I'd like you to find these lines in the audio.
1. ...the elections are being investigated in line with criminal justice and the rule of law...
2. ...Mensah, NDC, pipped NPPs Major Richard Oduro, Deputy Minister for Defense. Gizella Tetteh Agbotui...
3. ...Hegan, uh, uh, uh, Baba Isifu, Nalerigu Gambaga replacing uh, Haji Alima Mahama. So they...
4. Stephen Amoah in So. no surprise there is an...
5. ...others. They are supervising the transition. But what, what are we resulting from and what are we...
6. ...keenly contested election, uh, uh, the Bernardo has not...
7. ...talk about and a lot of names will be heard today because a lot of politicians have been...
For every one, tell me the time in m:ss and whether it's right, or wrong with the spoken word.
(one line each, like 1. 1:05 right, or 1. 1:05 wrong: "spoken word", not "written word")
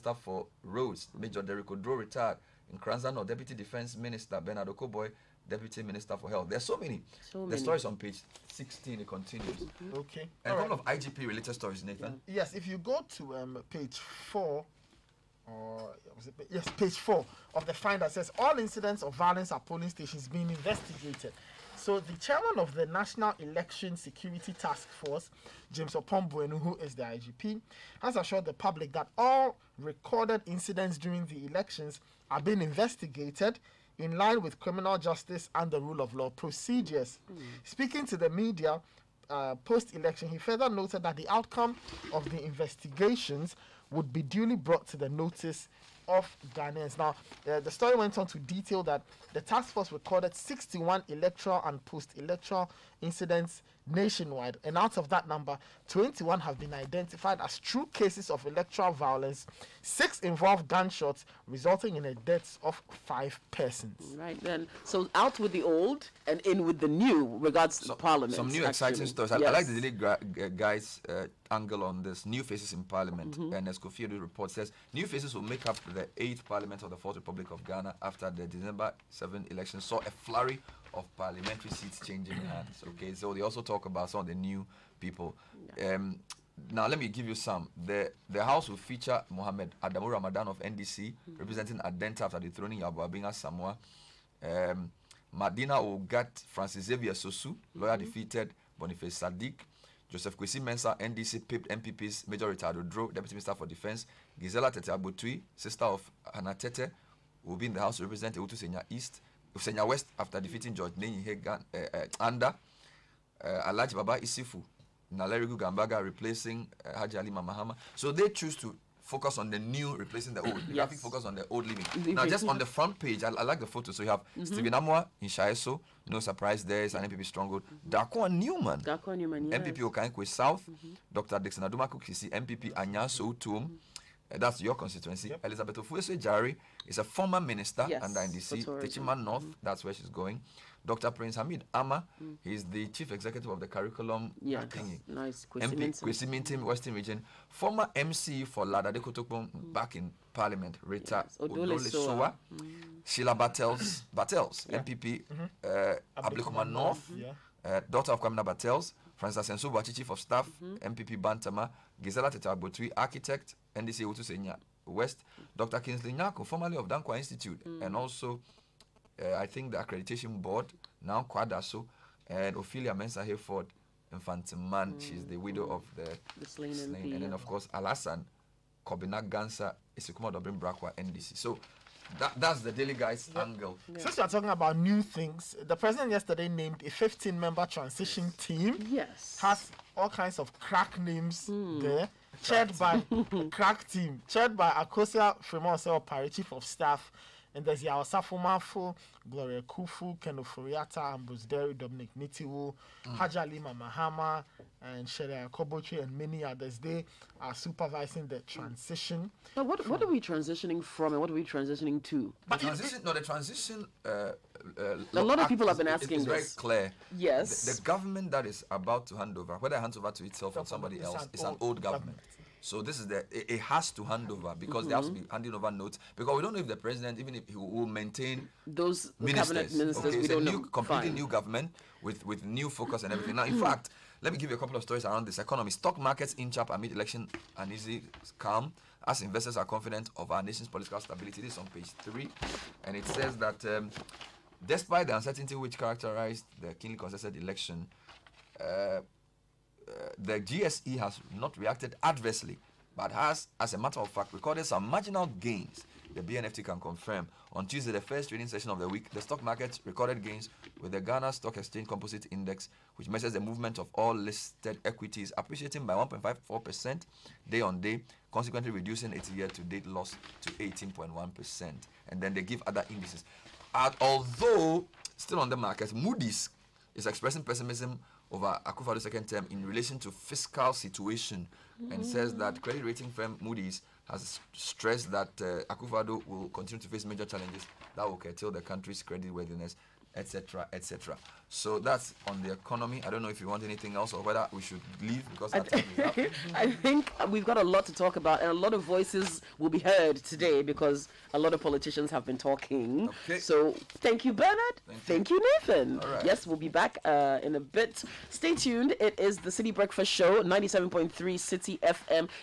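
1. 0:31 right
2. 1:40 right
3. 1:51 right
4. 2:04 right
5. 3:26 wrong: "transitioning", not "resulting"
6. 4:06 wrong: "GSE", not "Bernardo"
7. 4:57 wrong: "voices", not "names".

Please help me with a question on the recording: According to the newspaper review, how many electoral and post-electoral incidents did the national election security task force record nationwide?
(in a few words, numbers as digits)
61.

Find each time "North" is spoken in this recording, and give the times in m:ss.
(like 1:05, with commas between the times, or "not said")
2:19, 2:36.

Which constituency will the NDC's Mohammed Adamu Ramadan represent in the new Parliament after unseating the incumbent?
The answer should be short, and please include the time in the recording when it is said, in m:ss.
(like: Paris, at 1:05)
Adenta, at 1:31.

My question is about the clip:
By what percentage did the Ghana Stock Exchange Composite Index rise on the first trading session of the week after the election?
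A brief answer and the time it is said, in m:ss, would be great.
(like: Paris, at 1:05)
1.54%, at 4:25.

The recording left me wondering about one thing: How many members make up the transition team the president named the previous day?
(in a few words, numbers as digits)
15.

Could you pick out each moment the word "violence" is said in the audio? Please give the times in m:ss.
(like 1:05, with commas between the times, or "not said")
0:19, 0:58.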